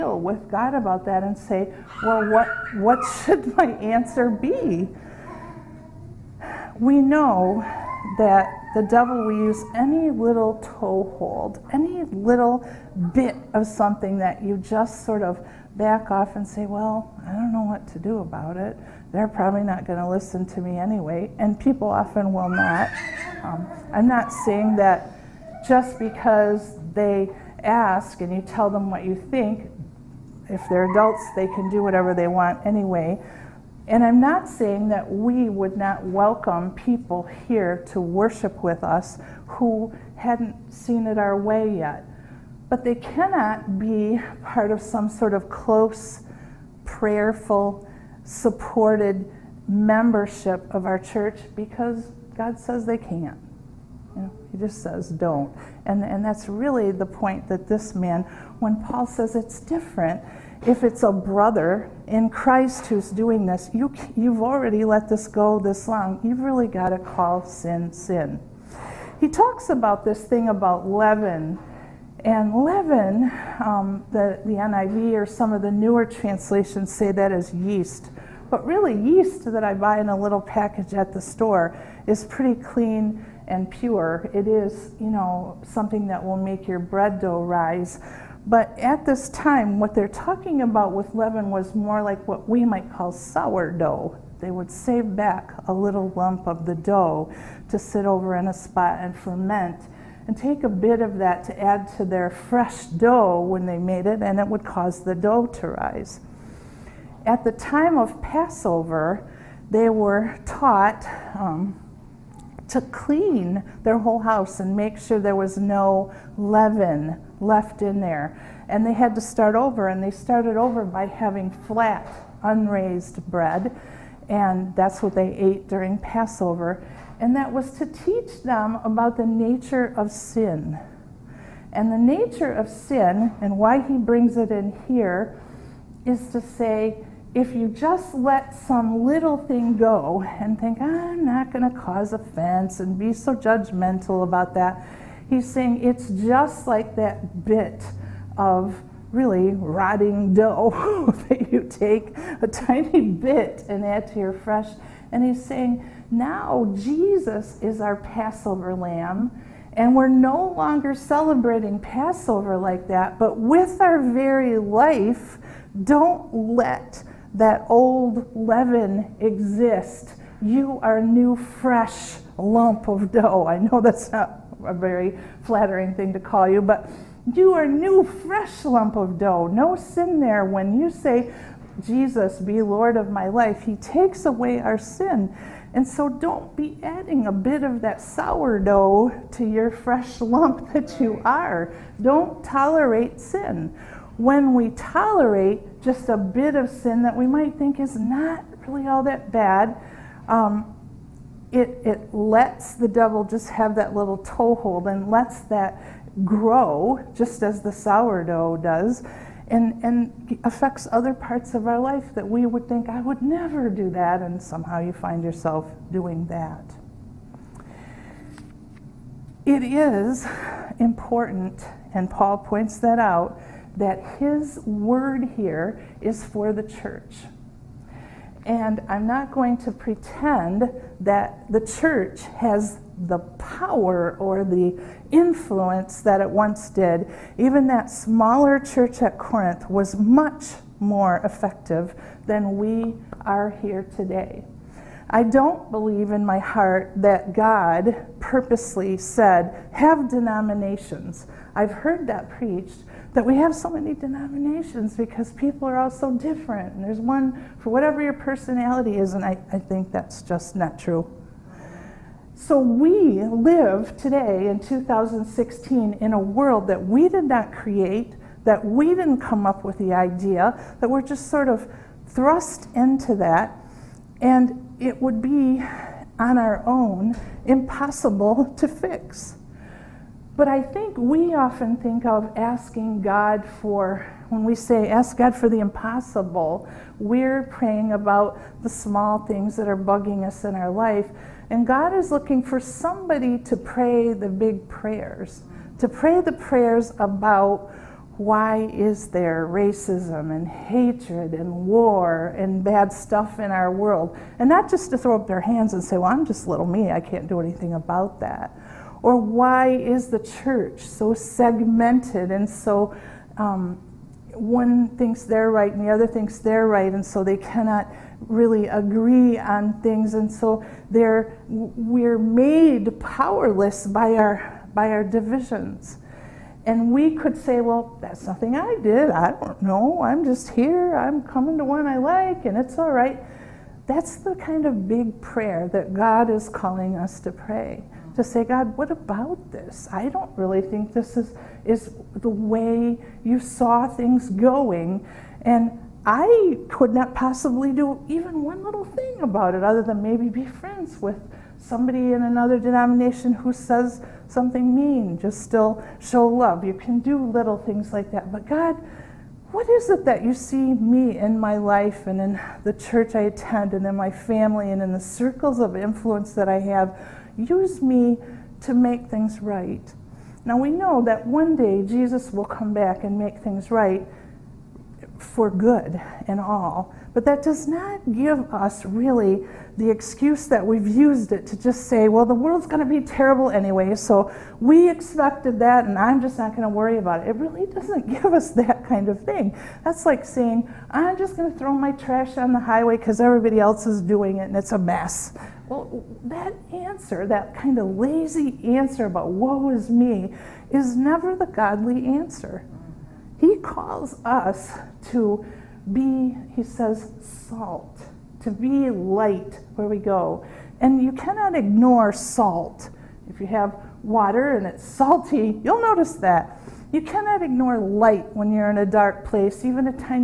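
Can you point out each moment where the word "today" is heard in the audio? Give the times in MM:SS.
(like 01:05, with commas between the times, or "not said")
04:03, 04:23.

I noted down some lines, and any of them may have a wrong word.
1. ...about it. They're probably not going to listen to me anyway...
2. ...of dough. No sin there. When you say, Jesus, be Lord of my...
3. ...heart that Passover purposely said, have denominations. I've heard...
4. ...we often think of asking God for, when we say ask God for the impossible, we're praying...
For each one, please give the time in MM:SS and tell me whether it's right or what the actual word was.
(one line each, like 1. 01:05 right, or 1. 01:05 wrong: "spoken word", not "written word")
1. 00:18 right
2. 02:58 right
3. 04:06 wrong: "God", not "Passover"
4. 04:40 right.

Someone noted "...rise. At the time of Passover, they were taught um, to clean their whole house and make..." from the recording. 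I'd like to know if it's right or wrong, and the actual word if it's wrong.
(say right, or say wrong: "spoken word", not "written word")
right.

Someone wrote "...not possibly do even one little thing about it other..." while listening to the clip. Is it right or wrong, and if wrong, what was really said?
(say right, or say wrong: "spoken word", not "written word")
right.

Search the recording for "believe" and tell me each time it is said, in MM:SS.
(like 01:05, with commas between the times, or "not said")
04:05.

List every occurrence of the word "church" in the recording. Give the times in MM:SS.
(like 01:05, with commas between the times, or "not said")
00:50, 03:46, 03:51, 03:58, 05:10, 06:02.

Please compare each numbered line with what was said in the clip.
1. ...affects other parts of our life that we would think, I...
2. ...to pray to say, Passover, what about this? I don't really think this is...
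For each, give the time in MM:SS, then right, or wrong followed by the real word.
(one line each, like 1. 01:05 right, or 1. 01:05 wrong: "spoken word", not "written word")
1. 03:30 right
2. 05:37 wrong: "God", not "Passover".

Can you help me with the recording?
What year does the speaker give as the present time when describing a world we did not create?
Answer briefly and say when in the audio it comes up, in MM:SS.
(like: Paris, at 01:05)
2016, at 04:24.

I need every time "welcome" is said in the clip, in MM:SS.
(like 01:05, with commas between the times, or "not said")
00:36.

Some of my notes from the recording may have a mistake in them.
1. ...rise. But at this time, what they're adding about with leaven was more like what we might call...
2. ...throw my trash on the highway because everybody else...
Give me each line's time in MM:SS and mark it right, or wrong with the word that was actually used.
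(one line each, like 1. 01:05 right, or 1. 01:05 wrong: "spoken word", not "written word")
1. 01:27 wrong: "talking", not "adding"
2. 06:31 right.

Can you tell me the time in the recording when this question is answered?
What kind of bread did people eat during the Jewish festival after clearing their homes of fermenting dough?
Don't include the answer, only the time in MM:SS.
02:01.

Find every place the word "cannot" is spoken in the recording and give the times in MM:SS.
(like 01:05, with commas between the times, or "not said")
00:42, 05:17, 06:51, 06:57.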